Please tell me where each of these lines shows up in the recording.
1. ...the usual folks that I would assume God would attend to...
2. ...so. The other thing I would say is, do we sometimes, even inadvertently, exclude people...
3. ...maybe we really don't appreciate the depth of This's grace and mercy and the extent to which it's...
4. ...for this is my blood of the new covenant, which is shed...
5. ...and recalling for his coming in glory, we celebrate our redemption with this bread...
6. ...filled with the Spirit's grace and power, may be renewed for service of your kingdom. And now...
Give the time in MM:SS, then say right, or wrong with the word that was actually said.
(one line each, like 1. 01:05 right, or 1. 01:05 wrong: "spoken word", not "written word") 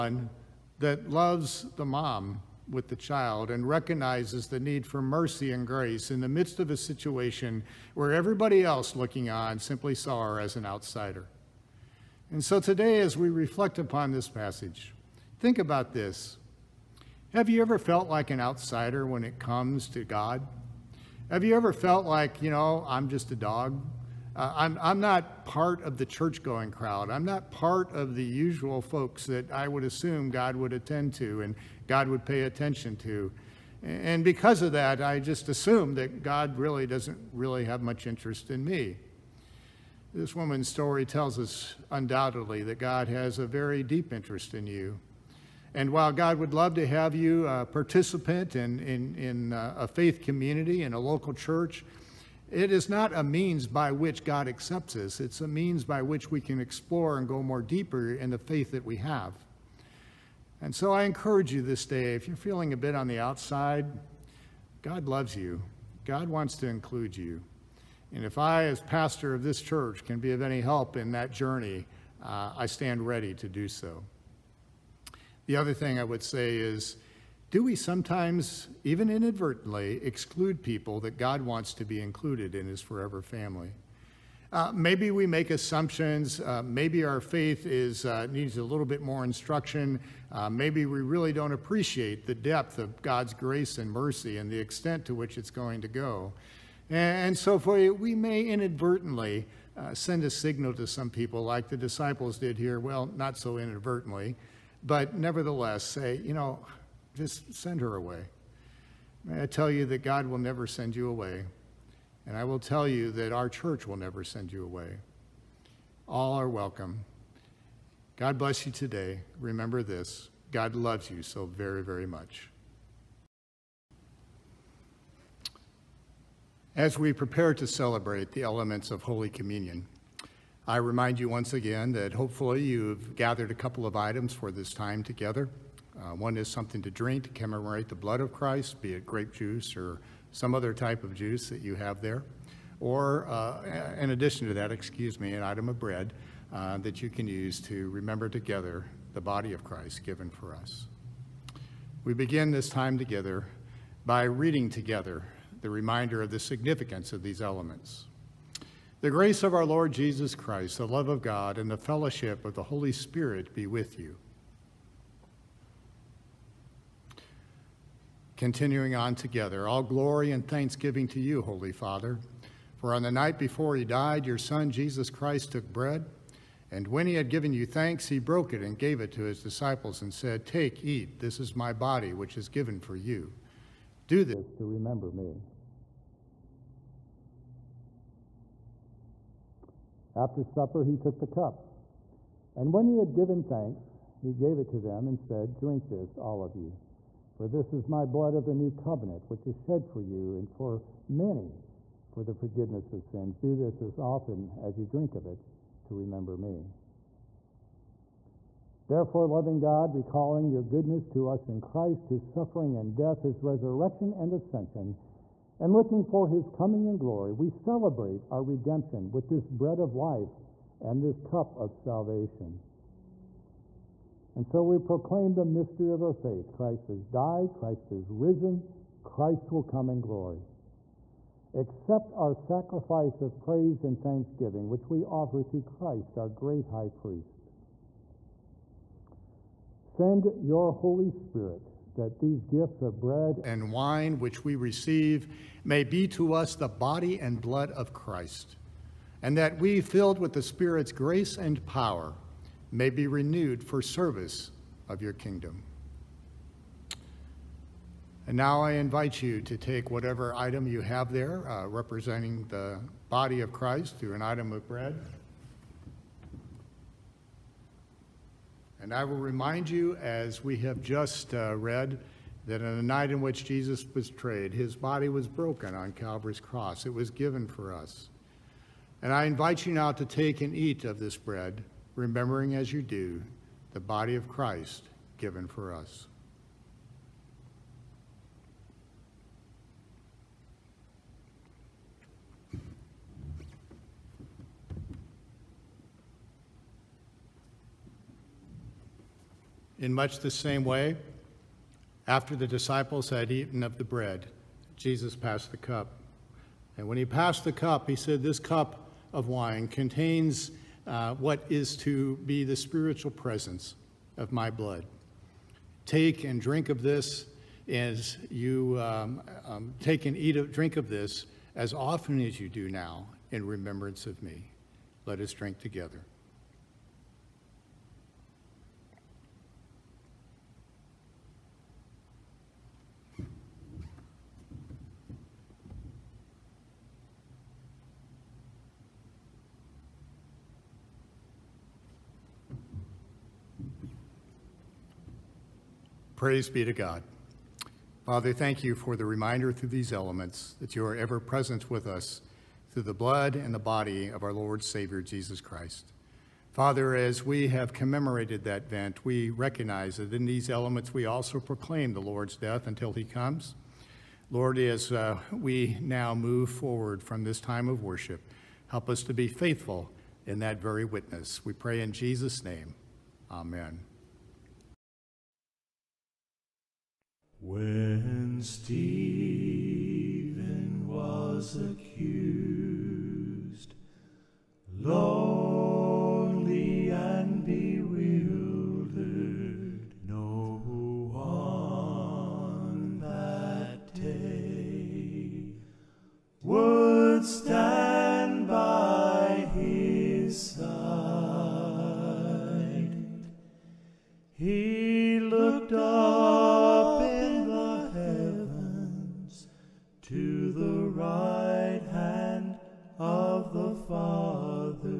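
1. 00:28 right
2. 01:13 right
3. 01:30 wrong: "God", not "This"
4. 03:17 right
5. 03:35 wrong: "looking", not "recalling"
6. 04:09 right.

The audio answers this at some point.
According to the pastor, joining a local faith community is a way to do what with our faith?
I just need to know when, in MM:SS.
00:56.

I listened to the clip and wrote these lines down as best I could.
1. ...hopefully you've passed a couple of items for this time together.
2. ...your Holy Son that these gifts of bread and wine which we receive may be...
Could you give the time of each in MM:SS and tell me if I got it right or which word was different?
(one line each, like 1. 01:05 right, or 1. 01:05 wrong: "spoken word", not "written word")
1. 02:12 wrong: "gathered", not "passed"
2. 04:00 wrong: "Spirit", not "Son".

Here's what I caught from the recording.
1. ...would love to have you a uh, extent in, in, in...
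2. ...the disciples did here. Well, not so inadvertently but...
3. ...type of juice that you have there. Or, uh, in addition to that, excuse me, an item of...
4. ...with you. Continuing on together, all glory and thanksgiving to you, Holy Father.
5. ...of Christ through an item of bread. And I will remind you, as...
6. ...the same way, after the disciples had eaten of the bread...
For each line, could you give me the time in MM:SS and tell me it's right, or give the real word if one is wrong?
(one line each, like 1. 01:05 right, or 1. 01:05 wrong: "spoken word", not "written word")
1. 00:46 wrong: "participant", not "extent"
2. 01:41 right
3. 02:20 right
4. 02:43 right
5. 04:23 right
6. 05:00 right.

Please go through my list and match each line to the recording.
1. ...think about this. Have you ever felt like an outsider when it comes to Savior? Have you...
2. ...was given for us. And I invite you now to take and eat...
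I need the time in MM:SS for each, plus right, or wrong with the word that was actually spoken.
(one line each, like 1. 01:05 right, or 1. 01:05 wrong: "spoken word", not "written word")
1. 00:15 wrong: "God", not "Savior"
2. 04:36 right.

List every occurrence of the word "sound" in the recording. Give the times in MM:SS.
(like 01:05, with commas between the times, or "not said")
not said.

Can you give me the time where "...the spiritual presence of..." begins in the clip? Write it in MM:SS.
05:12.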